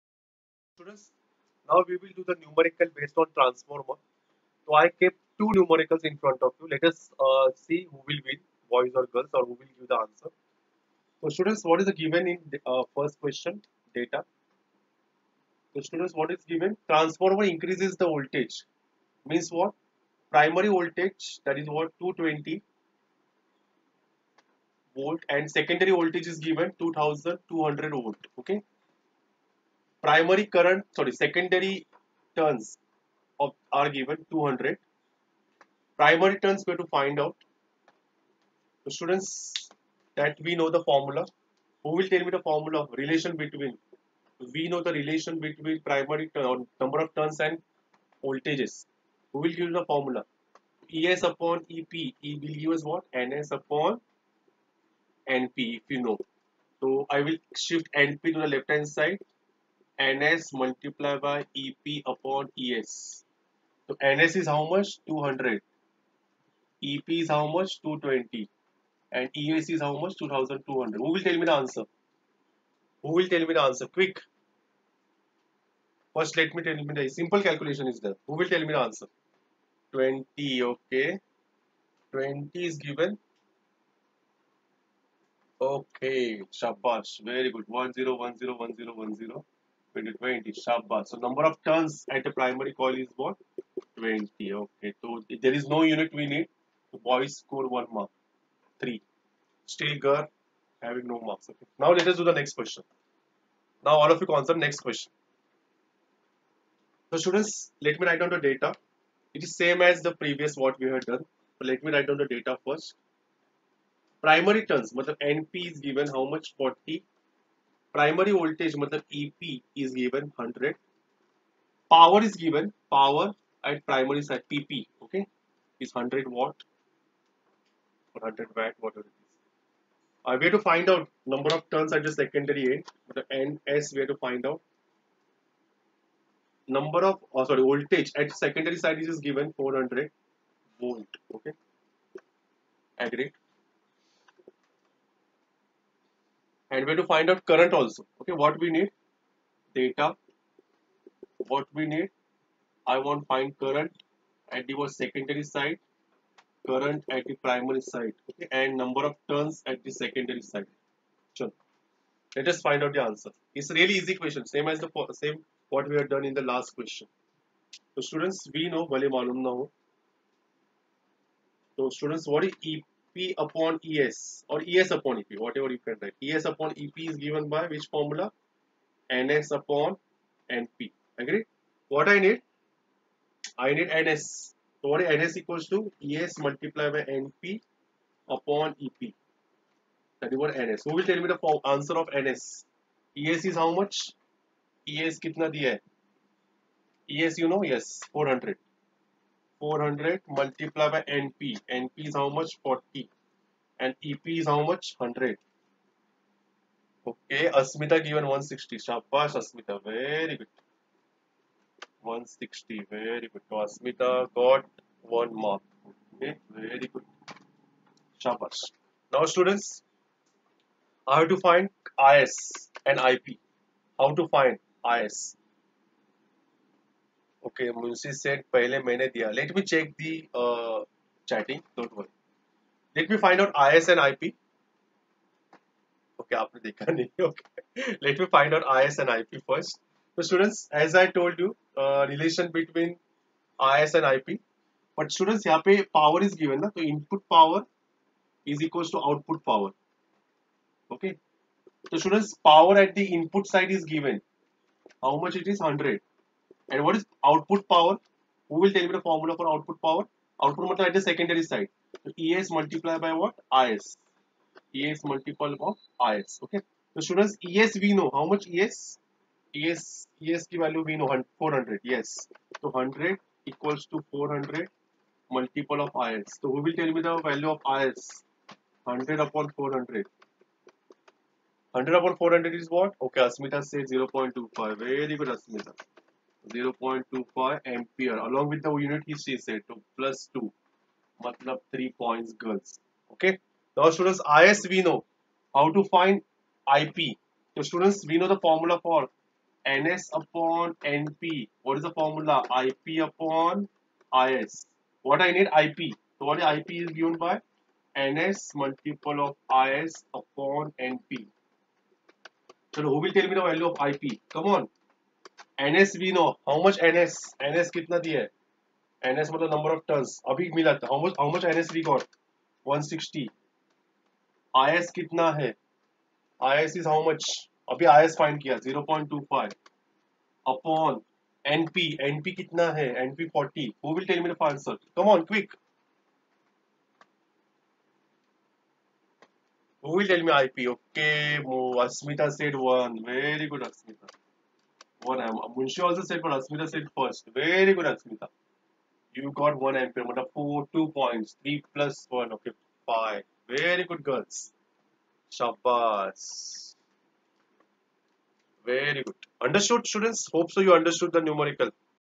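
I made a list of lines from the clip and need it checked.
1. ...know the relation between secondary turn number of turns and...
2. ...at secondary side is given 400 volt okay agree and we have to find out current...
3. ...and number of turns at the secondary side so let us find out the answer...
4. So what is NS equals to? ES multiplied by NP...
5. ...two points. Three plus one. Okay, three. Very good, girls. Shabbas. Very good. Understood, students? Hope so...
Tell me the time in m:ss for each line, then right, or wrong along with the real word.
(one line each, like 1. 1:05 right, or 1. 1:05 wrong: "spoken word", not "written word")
1. 0:44 wrong: "primary", not "secondary"
2. 2:18 right
3. 2:38 right
4. 3:04 right
5. 5:50 wrong: "five", not "three".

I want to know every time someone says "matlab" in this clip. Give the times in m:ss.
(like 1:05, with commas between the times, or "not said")
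1:58, 4:20, 4:51.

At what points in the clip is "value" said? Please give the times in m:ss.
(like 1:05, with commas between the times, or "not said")
4:30, 4:37, 5:13.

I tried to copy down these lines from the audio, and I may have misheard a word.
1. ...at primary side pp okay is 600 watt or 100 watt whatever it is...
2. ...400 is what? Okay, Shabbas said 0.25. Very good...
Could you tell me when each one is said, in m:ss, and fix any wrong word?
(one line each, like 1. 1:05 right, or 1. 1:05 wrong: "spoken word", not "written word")
1. 2:03 wrong: "100", not "600"
2. 4:42 wrong: "Asmita", not "Shabbas".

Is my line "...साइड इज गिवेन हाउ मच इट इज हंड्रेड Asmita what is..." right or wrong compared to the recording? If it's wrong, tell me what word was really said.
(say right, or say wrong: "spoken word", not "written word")
wrong: "And", not "Asmita".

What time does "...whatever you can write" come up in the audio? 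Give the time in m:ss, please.
2:55.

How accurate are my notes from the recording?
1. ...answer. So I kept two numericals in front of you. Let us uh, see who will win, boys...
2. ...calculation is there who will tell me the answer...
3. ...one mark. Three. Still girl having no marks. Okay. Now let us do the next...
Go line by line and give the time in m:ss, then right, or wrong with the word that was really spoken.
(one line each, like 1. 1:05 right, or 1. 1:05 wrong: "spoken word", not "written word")
1. 0:03 wrong: "transformer", not "answer"
2. 1:17 right
3. 1:37 right.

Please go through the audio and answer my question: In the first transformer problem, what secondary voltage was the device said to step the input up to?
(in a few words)
2200 volts.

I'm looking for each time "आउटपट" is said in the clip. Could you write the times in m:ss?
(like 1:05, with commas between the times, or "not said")
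4:08.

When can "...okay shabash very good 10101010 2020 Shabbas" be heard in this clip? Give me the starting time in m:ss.
1:25.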